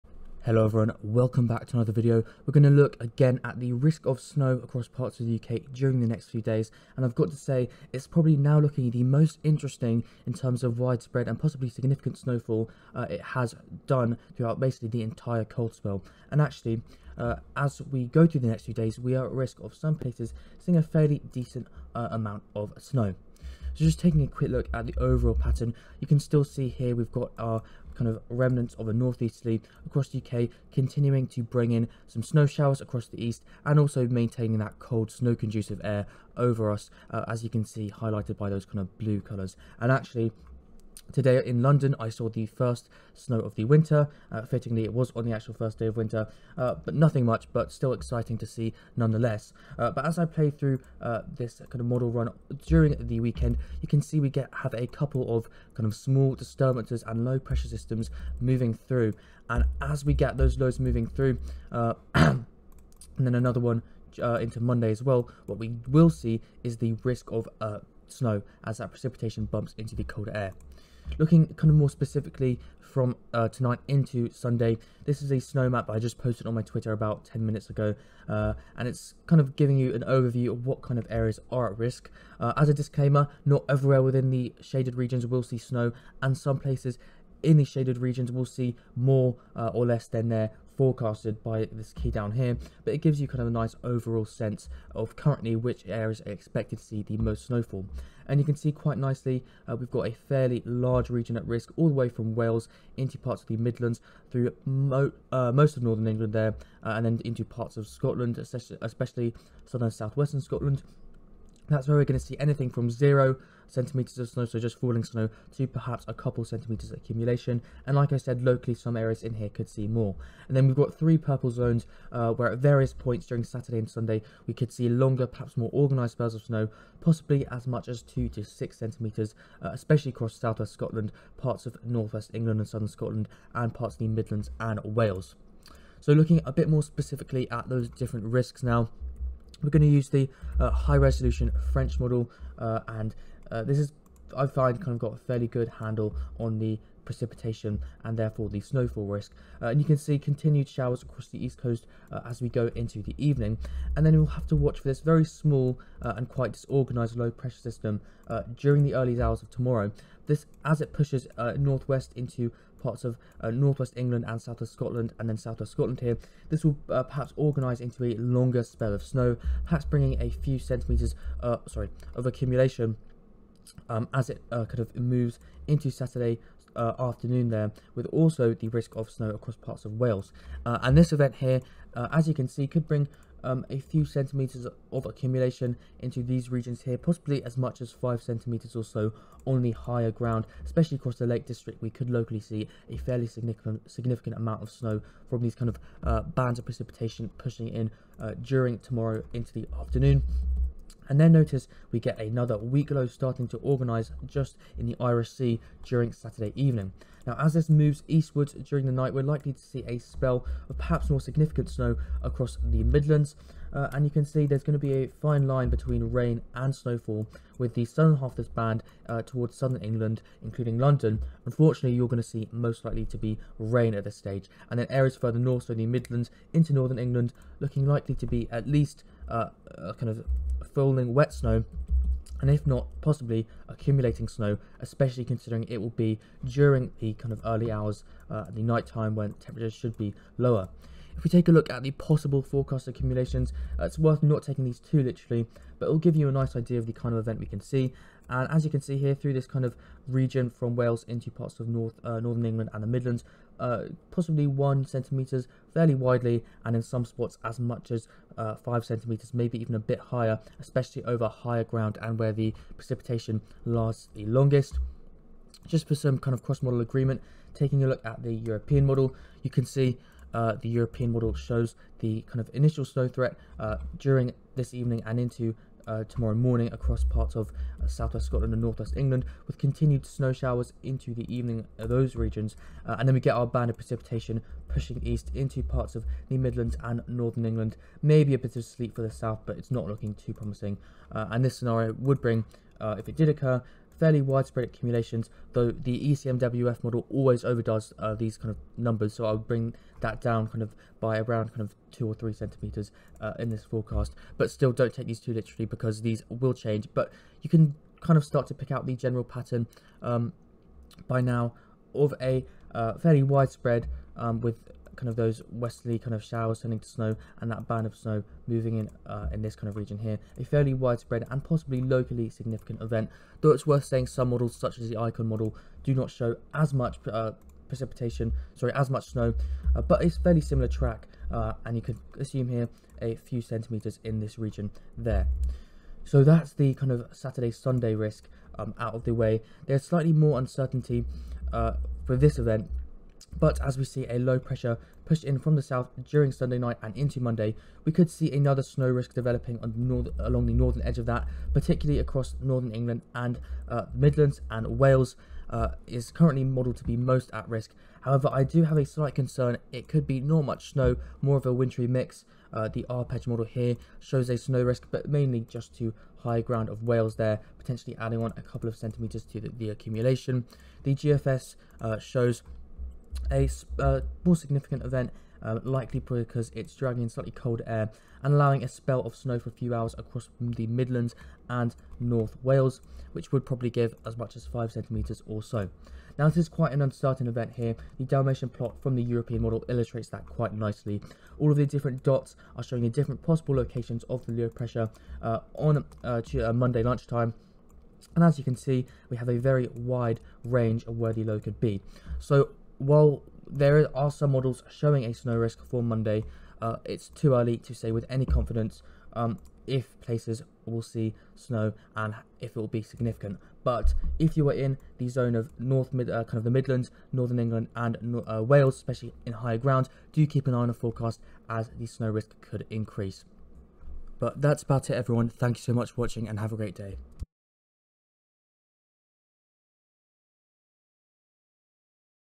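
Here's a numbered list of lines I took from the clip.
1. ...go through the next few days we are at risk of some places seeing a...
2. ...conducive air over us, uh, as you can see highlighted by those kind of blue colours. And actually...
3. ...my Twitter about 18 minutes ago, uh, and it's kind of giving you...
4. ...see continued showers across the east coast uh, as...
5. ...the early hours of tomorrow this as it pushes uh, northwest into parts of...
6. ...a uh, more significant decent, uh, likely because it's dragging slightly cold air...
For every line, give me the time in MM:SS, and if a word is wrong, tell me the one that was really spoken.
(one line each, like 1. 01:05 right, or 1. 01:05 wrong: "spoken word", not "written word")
1. 00:18 right
2. 00:35 right
3. 01:16 wrong: "10", not "18"
4. 02:29 right
5. 02:38 right
6. 06:13 wrong: "event", not "decent".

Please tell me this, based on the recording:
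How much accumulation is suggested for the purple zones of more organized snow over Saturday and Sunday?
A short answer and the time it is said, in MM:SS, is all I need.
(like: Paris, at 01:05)
2 to 6 centimeters, at 02:08.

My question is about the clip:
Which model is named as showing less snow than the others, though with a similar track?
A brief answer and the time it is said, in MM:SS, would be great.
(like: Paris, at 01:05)
Icon, at 05:24.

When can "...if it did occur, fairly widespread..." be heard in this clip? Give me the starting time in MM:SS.
04:52.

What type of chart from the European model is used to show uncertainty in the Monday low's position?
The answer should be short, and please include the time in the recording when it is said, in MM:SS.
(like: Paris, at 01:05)
Dalmatian plot, at 06:28.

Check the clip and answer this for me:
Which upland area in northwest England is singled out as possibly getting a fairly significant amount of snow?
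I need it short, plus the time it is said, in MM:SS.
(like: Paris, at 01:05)
Lake District, at 03:11.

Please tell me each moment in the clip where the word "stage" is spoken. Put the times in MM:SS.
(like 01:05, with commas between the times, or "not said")
03:44.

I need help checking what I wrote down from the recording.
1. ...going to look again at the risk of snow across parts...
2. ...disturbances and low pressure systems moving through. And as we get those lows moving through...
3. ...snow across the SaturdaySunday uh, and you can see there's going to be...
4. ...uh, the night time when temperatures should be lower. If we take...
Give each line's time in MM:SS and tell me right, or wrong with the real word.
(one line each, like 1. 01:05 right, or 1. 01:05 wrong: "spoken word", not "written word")
1. 00:02 right
2. 00:56 right
3. 03:31 wrong: "Midlands", not "SaturdaySunday"
4. 03:58 right.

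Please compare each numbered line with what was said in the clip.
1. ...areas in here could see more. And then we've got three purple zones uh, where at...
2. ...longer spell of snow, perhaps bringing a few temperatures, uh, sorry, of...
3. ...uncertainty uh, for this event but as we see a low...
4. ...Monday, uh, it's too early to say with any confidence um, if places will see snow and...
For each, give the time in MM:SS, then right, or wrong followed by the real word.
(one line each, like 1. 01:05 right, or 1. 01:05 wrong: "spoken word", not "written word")
1. 01:58 right
2. 02:48 wrong: "centimetres", not "temperatures"
3. 05:40 right
4. 06:45 right.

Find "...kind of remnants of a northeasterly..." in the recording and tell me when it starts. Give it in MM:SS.
00:27.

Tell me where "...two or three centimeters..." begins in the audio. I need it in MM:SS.
05:01.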